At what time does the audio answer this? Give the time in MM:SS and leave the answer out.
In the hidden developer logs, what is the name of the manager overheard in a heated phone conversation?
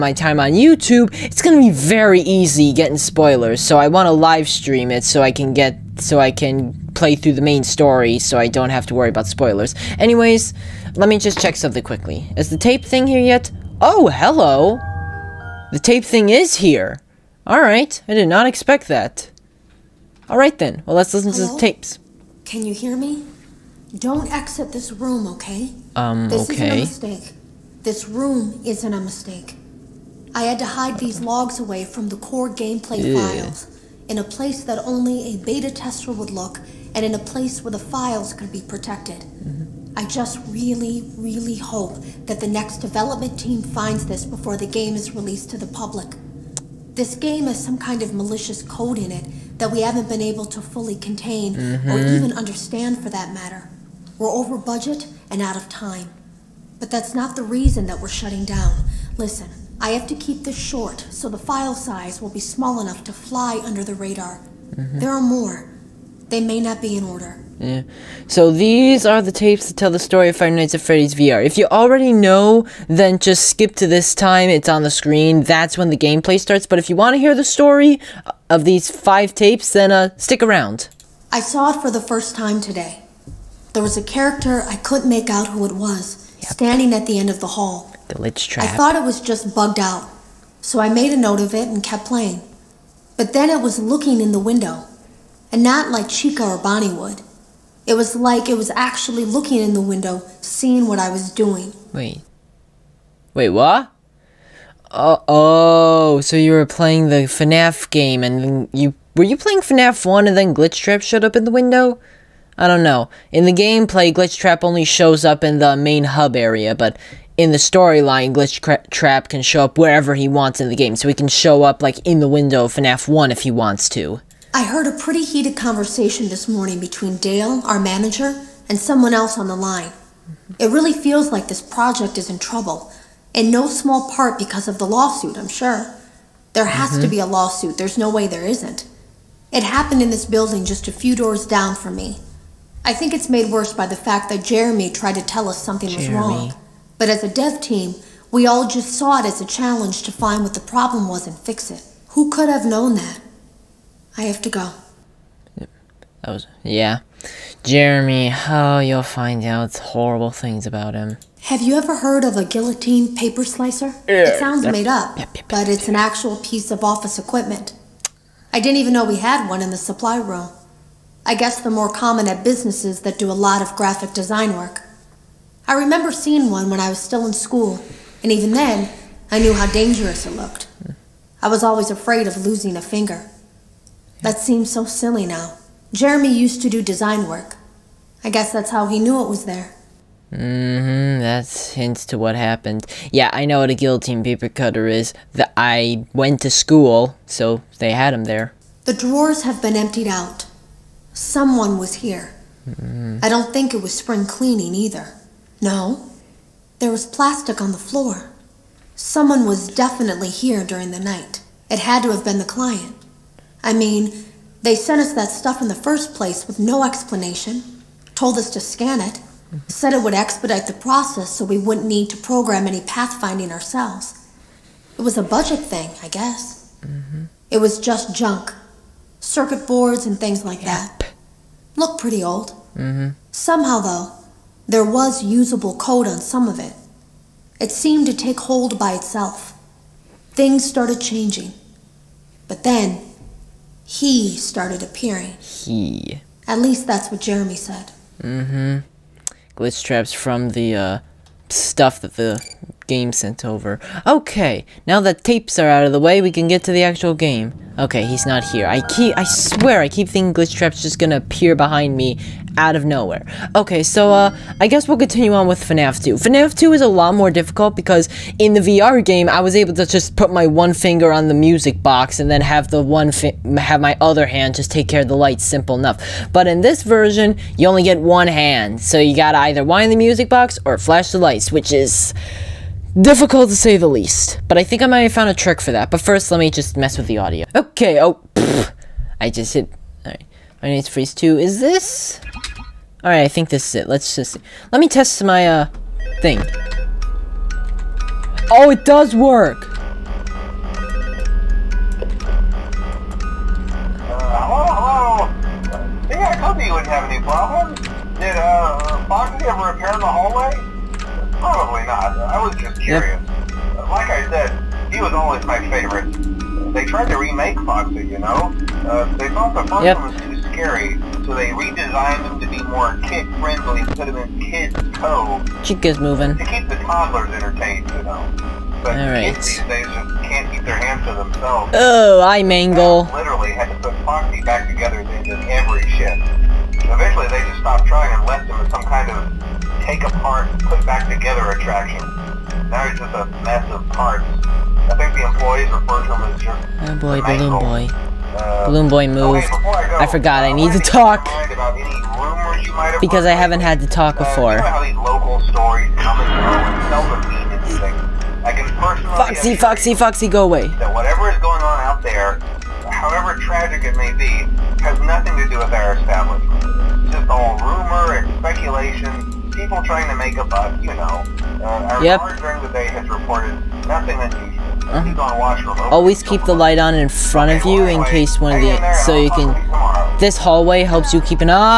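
02:07.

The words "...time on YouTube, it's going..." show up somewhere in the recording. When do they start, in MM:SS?
00:00.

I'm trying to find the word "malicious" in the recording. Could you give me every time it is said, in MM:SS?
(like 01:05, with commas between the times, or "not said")
00:48.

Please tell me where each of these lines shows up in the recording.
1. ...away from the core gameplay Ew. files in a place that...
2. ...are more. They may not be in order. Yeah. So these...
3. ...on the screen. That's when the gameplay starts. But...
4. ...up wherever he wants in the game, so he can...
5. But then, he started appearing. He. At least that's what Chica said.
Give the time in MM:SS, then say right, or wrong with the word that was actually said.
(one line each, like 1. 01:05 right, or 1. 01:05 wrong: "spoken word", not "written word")
1. 00:31 right
2. 01:05 right
3. 01:14 right
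4. 01:59 right
5. 04:02 wrong: "Jeremy", not "Chica".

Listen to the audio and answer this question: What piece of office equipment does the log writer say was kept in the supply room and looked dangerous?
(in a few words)
guillotine paper slicer.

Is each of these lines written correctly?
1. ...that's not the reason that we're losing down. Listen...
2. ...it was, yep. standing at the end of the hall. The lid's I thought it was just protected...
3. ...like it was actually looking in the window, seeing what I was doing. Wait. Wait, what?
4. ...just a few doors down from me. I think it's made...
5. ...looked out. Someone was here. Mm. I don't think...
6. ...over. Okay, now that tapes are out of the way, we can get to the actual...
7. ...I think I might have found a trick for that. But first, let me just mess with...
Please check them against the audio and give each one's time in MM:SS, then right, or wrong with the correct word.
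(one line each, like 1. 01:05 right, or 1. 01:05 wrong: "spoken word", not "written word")
1. 00:56 wrong: "shutting", not "losing"
2. 01:25 wrong: "bugged", not "protected"
3. 01:38 right
4. 02:20 right
5. 03:19 wrong: "emptied", not "looked"
6. 04:13 right
7. 04:44 right.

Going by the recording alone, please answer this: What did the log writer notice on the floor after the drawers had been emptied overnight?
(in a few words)
plastic.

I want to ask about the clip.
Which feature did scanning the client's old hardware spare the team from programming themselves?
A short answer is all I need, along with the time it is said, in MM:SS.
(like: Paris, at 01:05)
pathfinding, at 03:42.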